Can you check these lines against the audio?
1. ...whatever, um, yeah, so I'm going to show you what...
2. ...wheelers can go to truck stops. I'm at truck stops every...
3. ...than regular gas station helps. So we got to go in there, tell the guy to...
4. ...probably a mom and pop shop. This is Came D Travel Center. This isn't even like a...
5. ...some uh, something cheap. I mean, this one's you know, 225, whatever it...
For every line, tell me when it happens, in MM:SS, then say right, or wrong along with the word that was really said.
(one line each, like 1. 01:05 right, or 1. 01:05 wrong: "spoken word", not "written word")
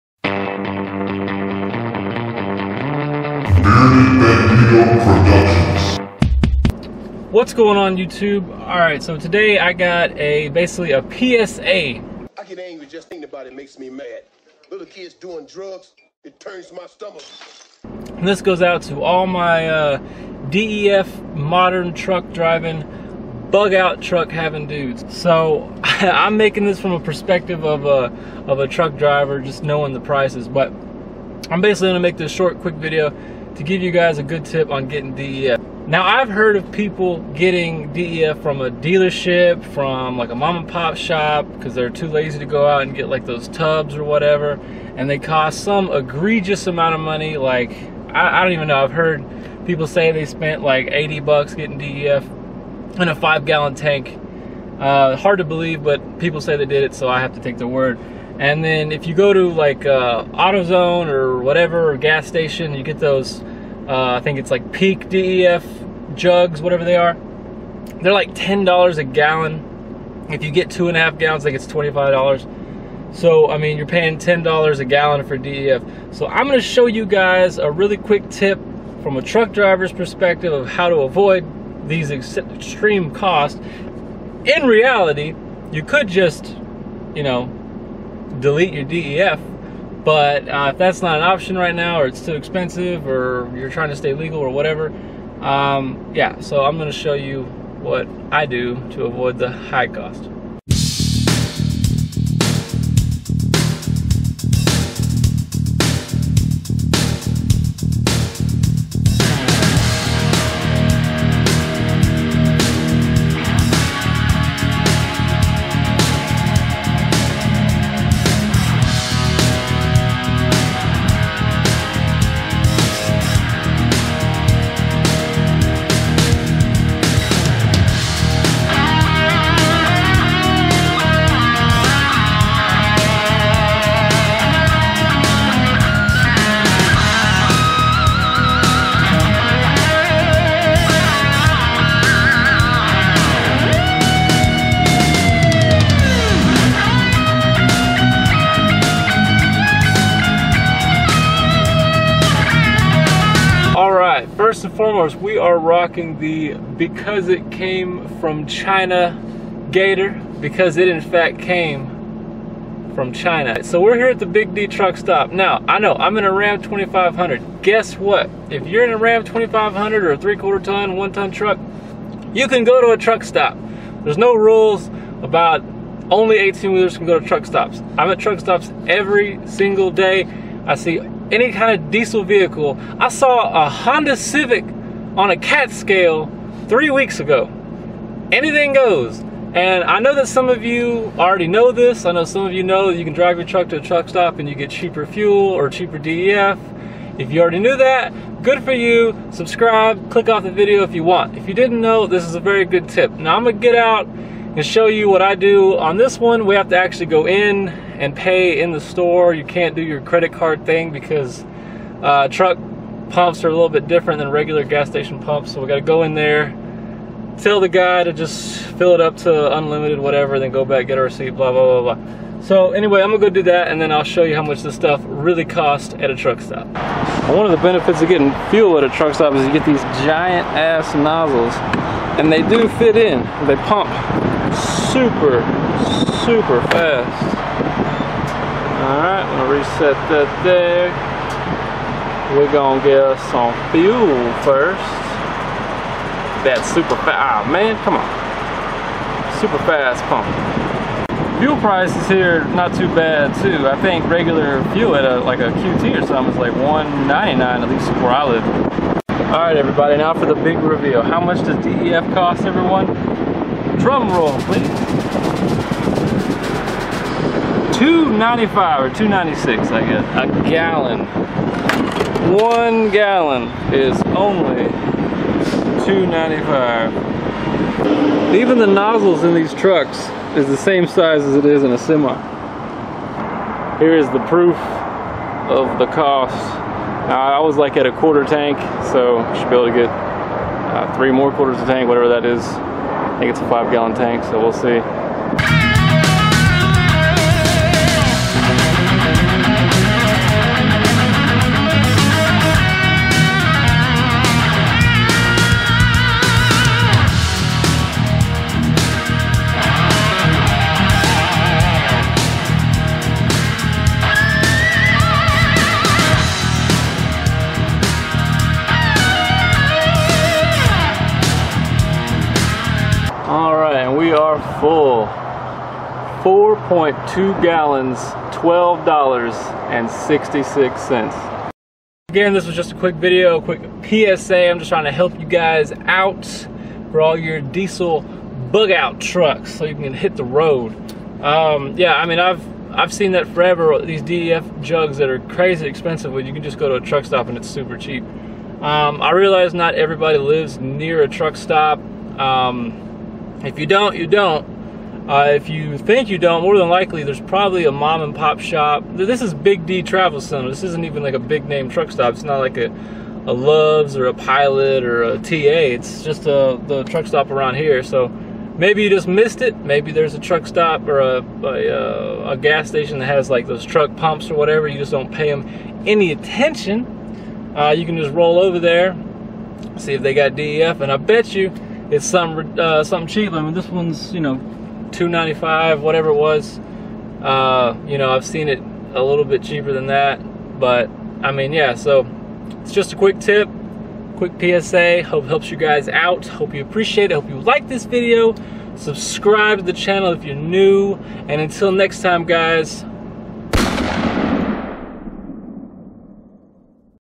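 1. 01:34 right
2. 02:56 right
3. 03:34 wrong: "pumps", not "helps"
4. 05:57 wrong: "Big", not "Came"
5. 06:22 wrong: "295", not "225".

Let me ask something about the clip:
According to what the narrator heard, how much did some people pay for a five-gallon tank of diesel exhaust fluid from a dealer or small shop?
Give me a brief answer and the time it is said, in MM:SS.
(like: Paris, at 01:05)
$80, at 00:50.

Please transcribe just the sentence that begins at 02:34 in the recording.
first and foremost, we are rocking the Because It Came From China Gator, because it in fact came from China.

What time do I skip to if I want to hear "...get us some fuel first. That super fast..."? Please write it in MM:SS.
04:02.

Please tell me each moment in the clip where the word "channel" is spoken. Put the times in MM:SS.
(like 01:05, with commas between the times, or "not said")
06:39.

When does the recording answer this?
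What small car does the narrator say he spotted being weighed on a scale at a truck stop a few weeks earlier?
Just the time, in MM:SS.
03:03.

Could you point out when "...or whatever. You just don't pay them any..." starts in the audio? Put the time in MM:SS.
06:14.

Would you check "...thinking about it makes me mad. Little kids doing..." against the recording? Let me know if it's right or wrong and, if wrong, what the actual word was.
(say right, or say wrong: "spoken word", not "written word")
right.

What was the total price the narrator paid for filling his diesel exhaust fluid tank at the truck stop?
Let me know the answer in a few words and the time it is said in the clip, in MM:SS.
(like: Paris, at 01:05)
$12.66, at 05:28.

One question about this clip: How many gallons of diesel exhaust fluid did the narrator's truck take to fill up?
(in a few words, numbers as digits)
4.2 gallons.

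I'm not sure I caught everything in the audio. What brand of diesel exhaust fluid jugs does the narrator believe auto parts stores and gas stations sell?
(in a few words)
Peak.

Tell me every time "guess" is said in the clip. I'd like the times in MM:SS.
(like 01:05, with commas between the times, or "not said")
02:47, 04:29.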